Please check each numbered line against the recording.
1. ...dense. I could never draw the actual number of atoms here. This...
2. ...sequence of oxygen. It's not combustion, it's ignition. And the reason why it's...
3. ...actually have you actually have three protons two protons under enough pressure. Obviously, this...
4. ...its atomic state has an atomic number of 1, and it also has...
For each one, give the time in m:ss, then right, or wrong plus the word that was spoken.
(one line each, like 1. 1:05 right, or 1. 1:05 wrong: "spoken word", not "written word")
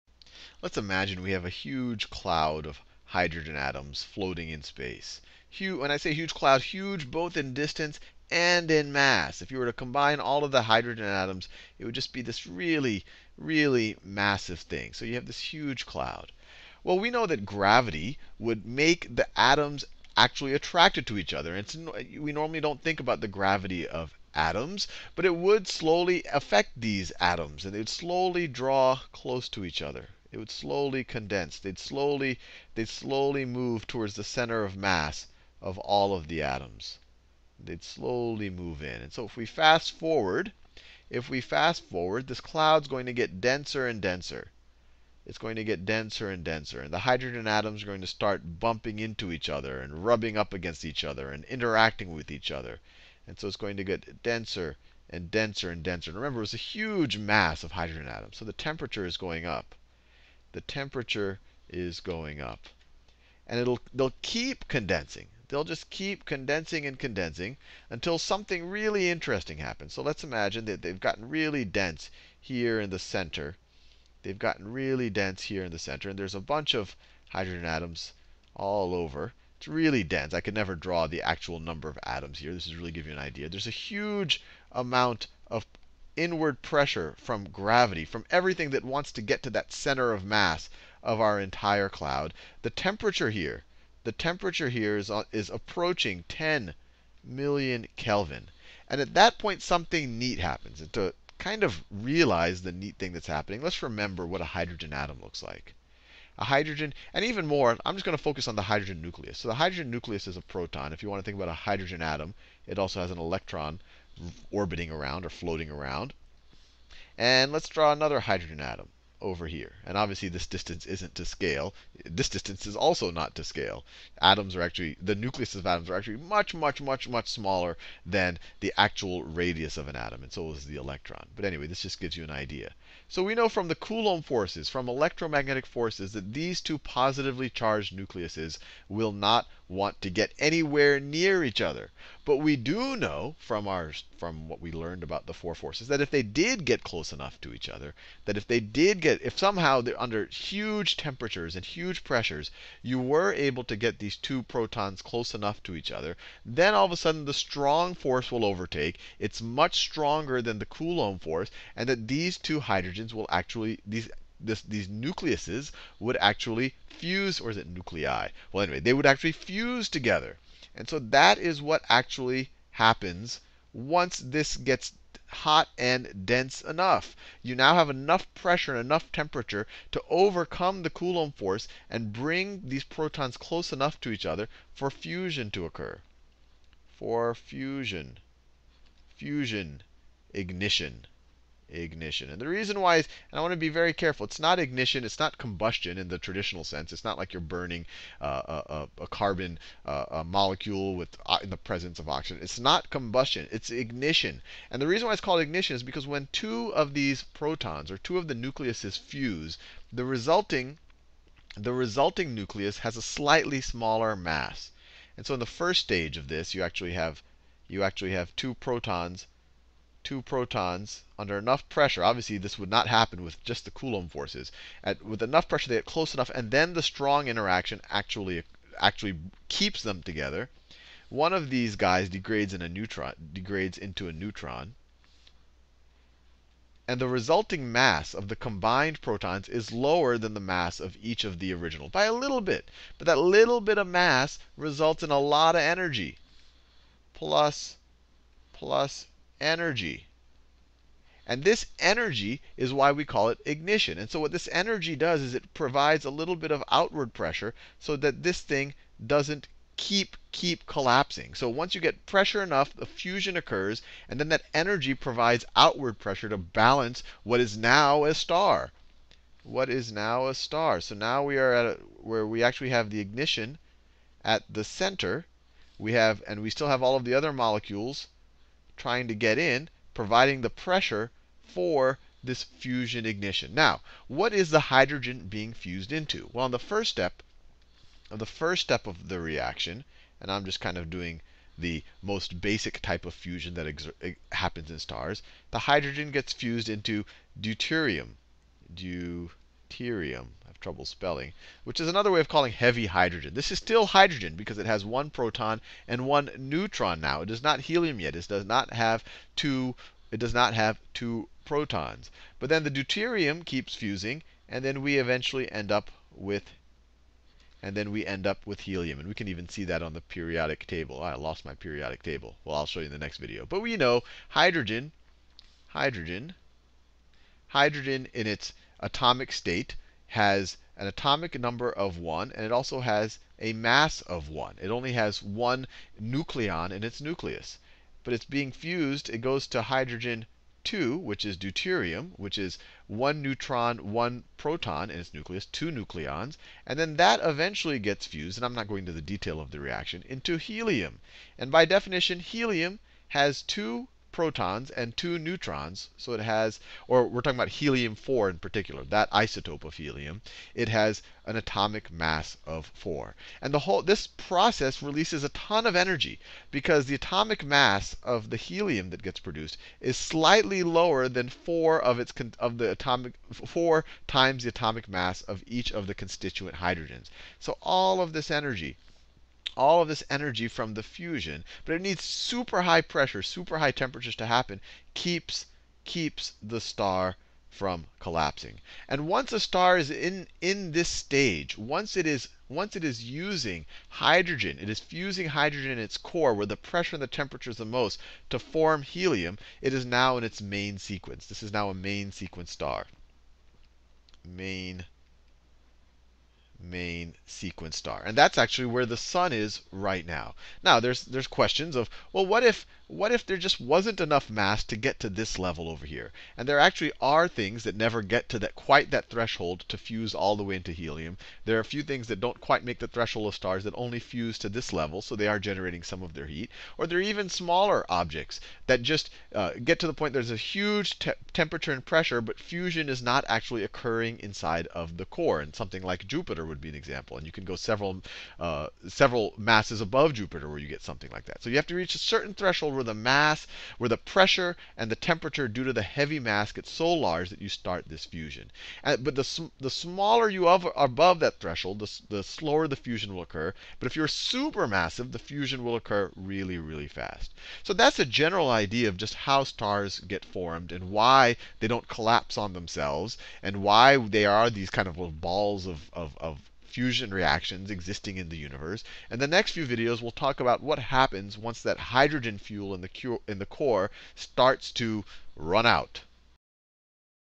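1. 1:20 right
2. 3:21 wrong: "presence", not "sequence"
3. 3:36 wrong: "two", not "three"
4. 5:28 right.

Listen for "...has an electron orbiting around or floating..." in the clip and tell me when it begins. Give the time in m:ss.
1:52.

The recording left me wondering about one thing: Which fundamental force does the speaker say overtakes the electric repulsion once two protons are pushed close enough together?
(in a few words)
strong force.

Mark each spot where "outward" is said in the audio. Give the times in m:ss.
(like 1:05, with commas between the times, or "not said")
4:16, 4:25.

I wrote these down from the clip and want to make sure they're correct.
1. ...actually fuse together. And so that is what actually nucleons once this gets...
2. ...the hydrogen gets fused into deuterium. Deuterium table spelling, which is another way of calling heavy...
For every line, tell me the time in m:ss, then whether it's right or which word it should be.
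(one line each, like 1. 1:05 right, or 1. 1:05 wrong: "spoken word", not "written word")
1. 2:49 wrong: "happens", not "nucleons"
2. 4:55 wrong: "trouble", not "table".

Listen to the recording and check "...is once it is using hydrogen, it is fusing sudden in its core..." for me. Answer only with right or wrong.
wrong.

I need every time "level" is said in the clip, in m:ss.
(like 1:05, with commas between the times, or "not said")
6:55, 7:04.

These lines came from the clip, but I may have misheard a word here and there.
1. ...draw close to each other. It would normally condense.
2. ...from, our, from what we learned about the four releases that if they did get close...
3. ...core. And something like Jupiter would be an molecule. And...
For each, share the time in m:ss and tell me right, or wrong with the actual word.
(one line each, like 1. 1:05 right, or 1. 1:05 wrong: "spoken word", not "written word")
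1. 0:28 wrong: "slowly", not "normally"
2. 2:23 wrong: "forces", not "releases"
3. 7:15 wrong: "example", not "molecule".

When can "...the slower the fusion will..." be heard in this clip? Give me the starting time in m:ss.
7:32.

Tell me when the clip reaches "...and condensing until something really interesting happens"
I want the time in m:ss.
1:06.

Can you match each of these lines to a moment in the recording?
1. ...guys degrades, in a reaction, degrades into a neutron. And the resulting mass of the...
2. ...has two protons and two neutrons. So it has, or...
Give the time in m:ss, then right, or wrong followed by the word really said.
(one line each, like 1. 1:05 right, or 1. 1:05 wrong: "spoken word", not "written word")
1. 3:51 wrong: "neutron", not "reaction"
2. 5:53 right.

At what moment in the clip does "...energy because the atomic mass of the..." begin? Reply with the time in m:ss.
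6:05.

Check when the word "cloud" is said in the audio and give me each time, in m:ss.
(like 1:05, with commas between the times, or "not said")
0:02, 0:06, 0:15, 0:42, 1:31.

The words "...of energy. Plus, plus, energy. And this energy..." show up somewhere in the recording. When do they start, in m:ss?
4:05.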